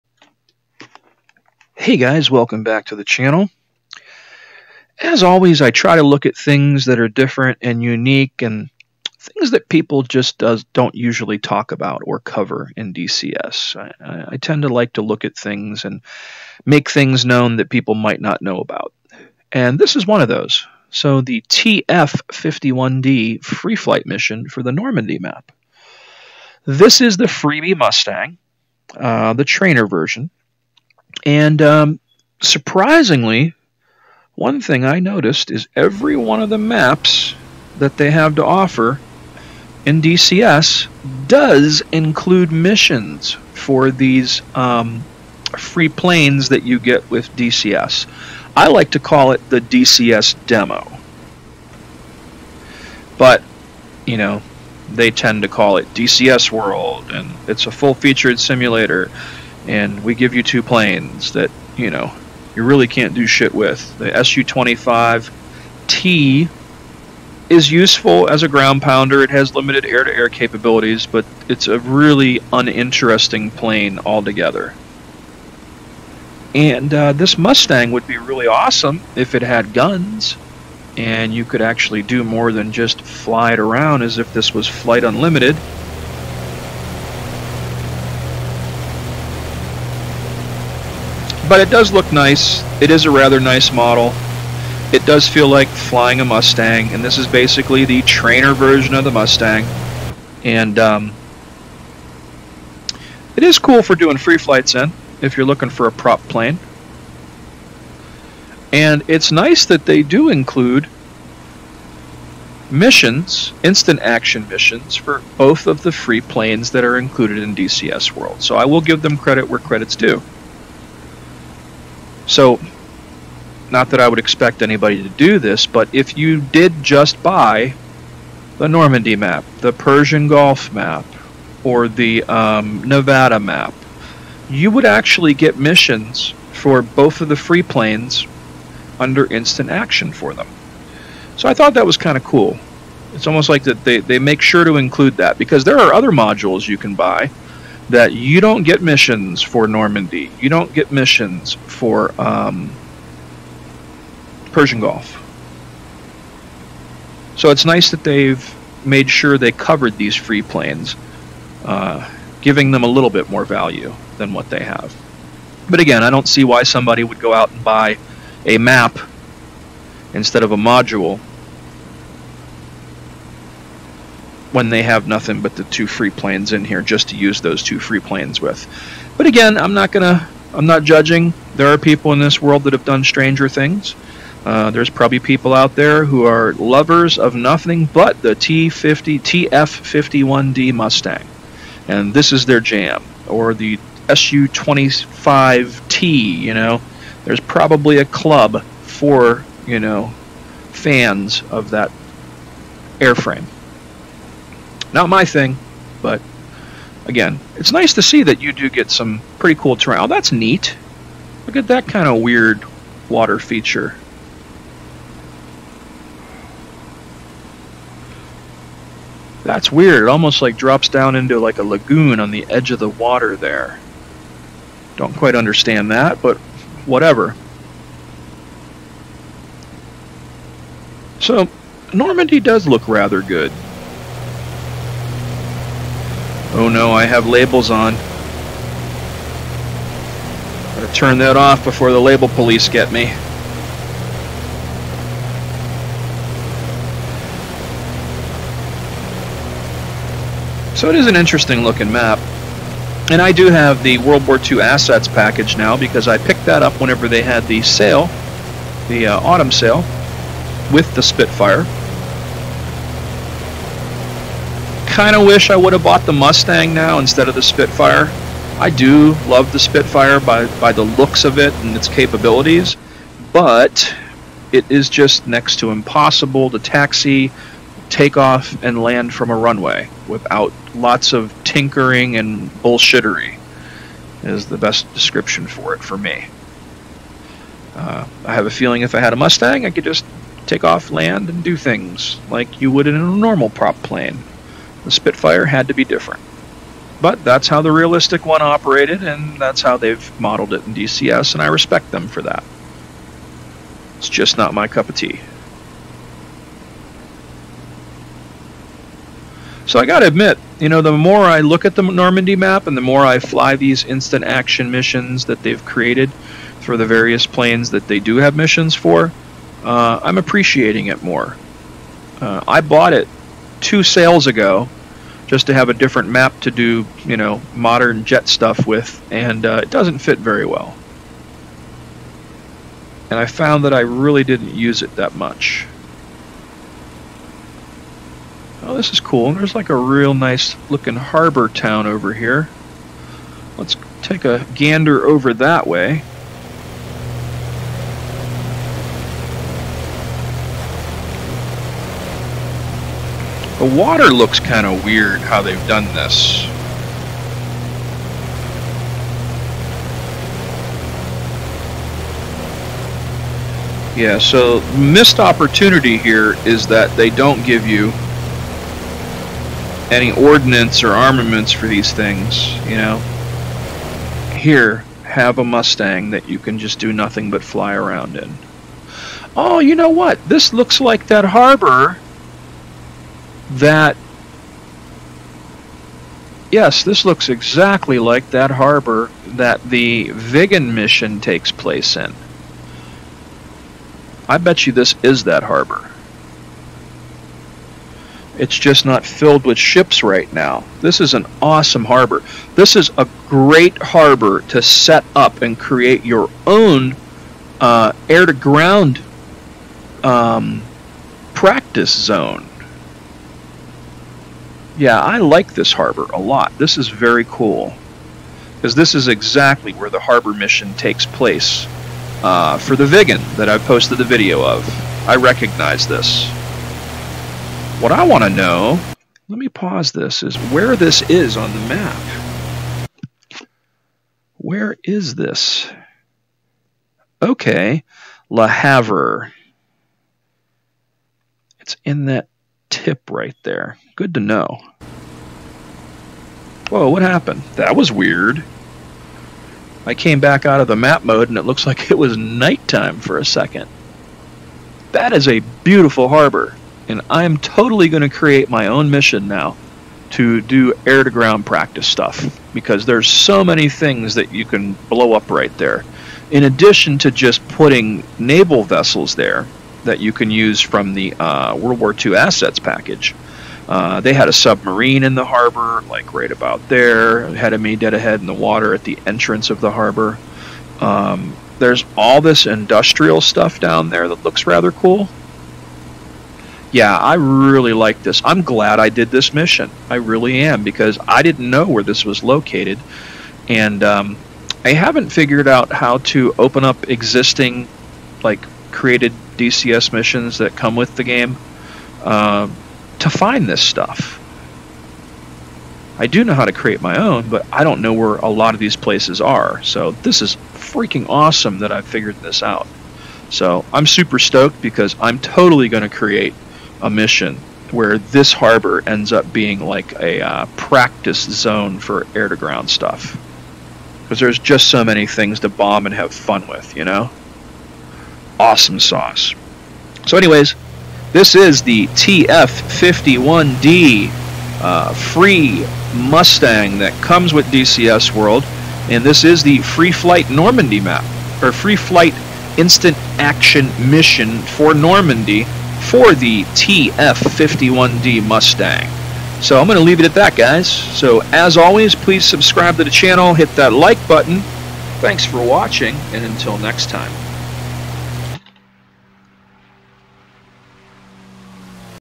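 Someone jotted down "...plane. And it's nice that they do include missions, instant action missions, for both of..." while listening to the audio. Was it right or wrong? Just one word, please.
right.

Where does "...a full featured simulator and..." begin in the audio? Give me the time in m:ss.
0:57.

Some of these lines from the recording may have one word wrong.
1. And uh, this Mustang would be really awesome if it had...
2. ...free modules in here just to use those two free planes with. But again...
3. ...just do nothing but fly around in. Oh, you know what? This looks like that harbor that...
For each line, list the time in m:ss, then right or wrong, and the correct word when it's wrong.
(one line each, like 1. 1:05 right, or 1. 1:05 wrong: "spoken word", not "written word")
1. 1:16 right
2. 2:55 wrong: "planes", not "modules"
3. 6:16 right.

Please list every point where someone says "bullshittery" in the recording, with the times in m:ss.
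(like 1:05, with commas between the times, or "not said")
4:42.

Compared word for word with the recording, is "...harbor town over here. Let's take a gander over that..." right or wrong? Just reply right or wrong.
right.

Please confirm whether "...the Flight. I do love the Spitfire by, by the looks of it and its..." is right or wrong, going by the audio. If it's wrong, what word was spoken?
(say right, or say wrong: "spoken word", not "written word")
wrong: "Spitfire", not "Flight".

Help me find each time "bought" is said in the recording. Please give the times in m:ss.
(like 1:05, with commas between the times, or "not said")
4:25, 5:22.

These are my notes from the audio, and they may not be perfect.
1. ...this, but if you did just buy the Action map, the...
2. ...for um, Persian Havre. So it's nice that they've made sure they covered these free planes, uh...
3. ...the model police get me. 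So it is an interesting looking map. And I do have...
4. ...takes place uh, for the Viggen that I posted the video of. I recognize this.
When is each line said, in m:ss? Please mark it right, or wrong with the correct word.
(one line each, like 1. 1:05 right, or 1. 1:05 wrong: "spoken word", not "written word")
1. 2:05 wrong: "Normandy", not "Action"
2. 2:31 wrong: "Gulf", not "Havre"
3. 4:01 wrong: "label", not "model"
4. 7:00 right.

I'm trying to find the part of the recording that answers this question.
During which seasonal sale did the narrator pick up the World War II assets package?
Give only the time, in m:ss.
4:19.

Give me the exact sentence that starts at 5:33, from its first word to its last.
And I found that I really didn't use it that much.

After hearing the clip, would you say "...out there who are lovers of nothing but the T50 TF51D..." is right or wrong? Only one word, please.
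right.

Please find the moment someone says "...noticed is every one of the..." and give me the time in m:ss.
0:34.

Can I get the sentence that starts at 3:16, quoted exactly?
You know, there's probably a club for you know fans of that airframe.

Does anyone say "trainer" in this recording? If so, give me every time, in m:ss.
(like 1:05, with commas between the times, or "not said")
0:29, 1:38.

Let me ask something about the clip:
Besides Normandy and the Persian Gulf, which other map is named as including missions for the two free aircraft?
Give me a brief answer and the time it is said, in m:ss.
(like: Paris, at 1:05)
Nevada, at 2:12.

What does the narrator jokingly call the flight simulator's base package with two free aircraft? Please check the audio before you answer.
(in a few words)
DCS demo.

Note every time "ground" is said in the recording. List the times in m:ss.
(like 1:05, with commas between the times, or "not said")
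1:08, 6:48, 7:41, 8:42.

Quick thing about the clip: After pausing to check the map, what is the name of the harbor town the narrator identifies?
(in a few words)
Le Havre.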